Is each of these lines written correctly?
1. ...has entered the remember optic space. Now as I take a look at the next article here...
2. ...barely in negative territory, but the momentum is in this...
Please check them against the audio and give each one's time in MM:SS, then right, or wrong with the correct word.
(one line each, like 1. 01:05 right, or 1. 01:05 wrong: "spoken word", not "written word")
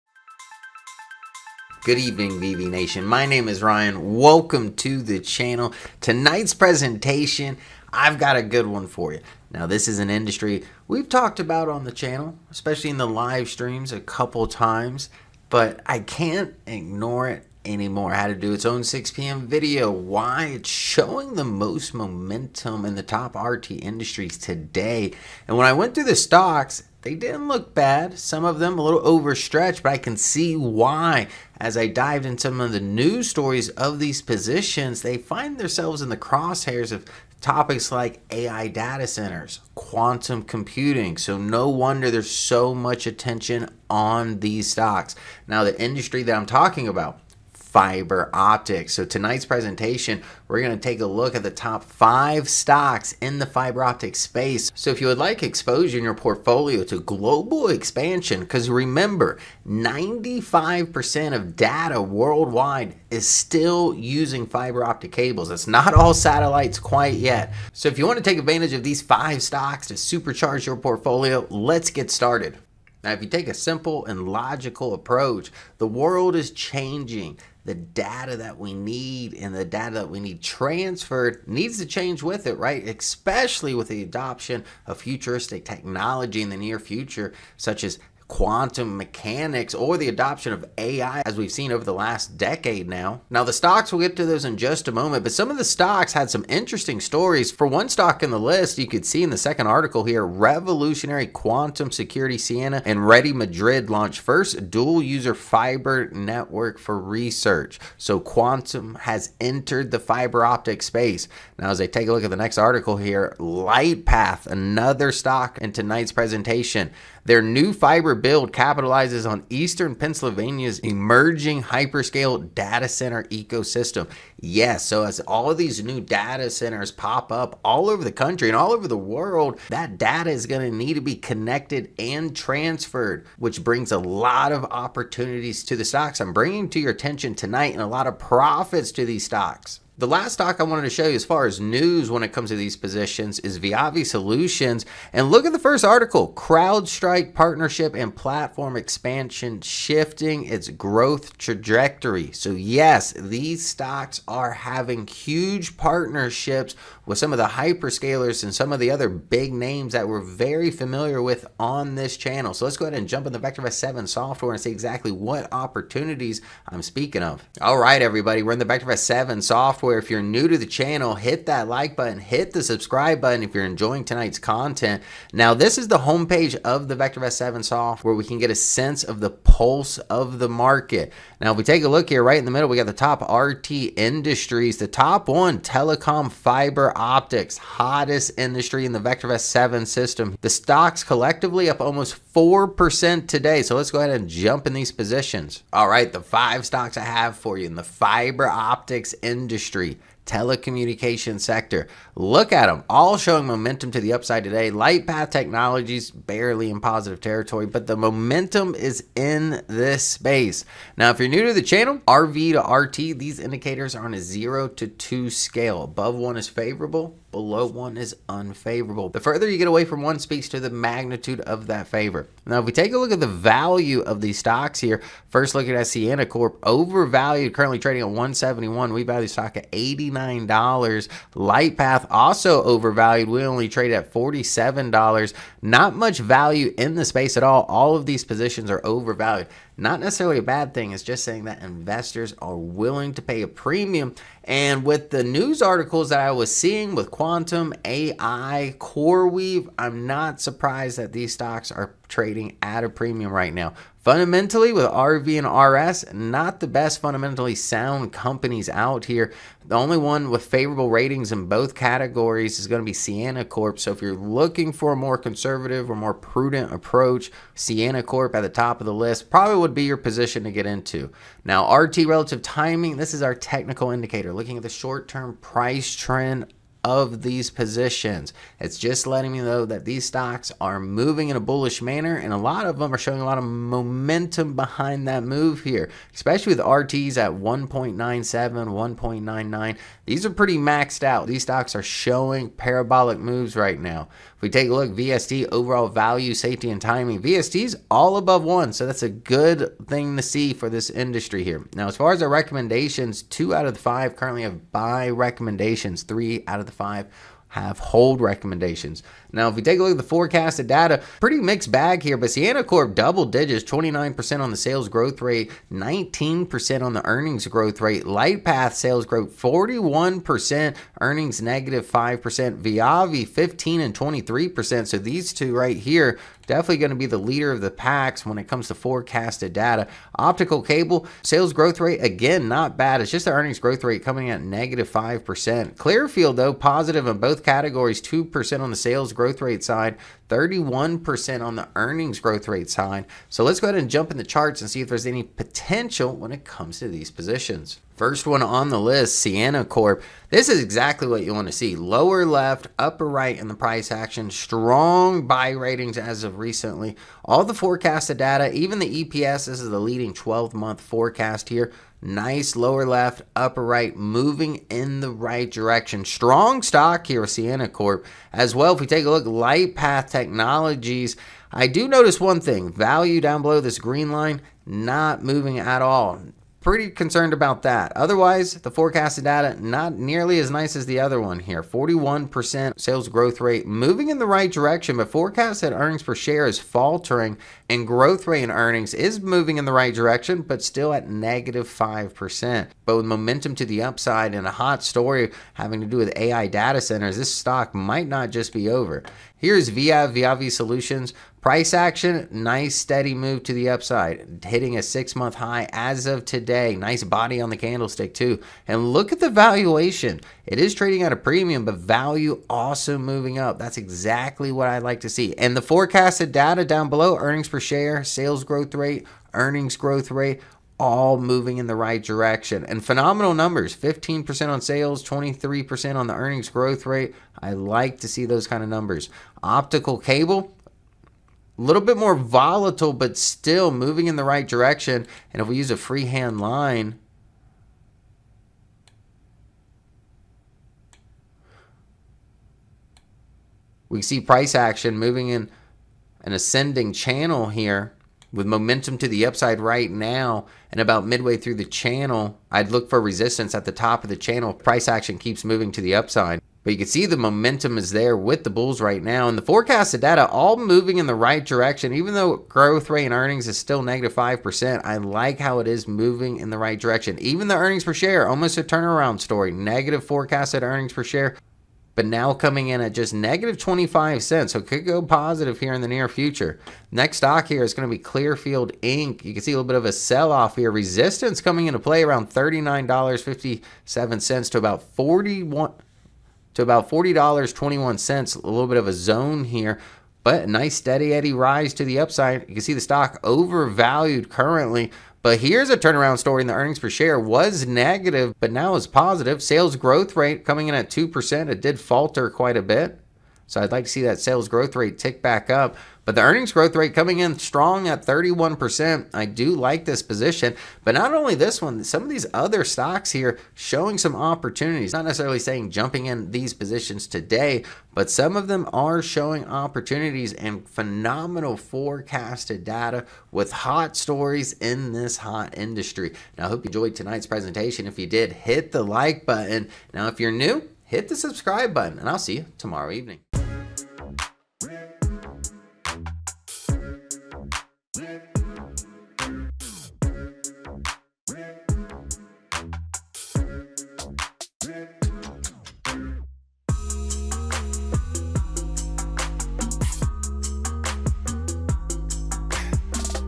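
1. 01:49 wrong: "fiber", not "remember"
2. 03:26 wrong: "positive", not "negative".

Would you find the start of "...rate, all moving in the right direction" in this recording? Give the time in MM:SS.
07:00.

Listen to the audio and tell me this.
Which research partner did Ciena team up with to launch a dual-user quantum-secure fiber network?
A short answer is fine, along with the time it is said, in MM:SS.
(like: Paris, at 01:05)
Ready Madrid, at 01:43.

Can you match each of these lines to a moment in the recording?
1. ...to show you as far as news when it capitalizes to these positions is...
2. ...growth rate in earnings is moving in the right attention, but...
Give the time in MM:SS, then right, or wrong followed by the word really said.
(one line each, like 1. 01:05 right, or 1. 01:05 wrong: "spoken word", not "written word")
1. 02:20 wrong: "comes", not "capitalizes"
2. 06:27 wrong: "direction", not "attention".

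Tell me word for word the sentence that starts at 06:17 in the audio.
Otherwise, the forecasted data not nearly as nice as the other one here.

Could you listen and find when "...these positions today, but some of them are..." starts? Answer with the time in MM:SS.
08:36.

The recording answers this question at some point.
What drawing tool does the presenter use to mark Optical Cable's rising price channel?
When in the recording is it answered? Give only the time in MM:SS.
07:15.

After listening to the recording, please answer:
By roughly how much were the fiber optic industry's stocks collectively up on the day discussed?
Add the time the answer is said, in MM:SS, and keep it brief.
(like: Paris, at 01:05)
almost 4%, at 03:11.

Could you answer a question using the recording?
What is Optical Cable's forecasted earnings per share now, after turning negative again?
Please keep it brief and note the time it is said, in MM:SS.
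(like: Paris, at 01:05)
-25 cents, at 07:53.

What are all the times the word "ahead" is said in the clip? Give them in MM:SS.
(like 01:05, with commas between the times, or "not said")
02:42, 03:13, 05:43.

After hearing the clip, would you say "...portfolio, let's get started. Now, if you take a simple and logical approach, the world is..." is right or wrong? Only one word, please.
right.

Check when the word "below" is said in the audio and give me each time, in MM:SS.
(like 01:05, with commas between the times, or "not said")
03:37, 06:13, 06:56.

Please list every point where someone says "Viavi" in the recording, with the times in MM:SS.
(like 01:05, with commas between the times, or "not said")
02:23, 05:22, 06:40.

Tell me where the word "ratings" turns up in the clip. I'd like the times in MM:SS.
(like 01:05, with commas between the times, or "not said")
04:20, 05:55.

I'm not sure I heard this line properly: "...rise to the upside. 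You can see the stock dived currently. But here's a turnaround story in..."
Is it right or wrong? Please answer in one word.
wrong.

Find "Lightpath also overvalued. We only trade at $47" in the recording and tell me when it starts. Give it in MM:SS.
03:51.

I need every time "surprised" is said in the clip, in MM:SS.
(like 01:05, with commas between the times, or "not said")
04:10.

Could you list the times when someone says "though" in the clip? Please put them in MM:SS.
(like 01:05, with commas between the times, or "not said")
05:36, 07:42.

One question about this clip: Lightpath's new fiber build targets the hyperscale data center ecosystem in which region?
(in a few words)
Eastern Pennsylvania.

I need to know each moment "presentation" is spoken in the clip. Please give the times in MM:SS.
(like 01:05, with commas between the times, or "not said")
00:06, 00:49, 01:56, 08:47.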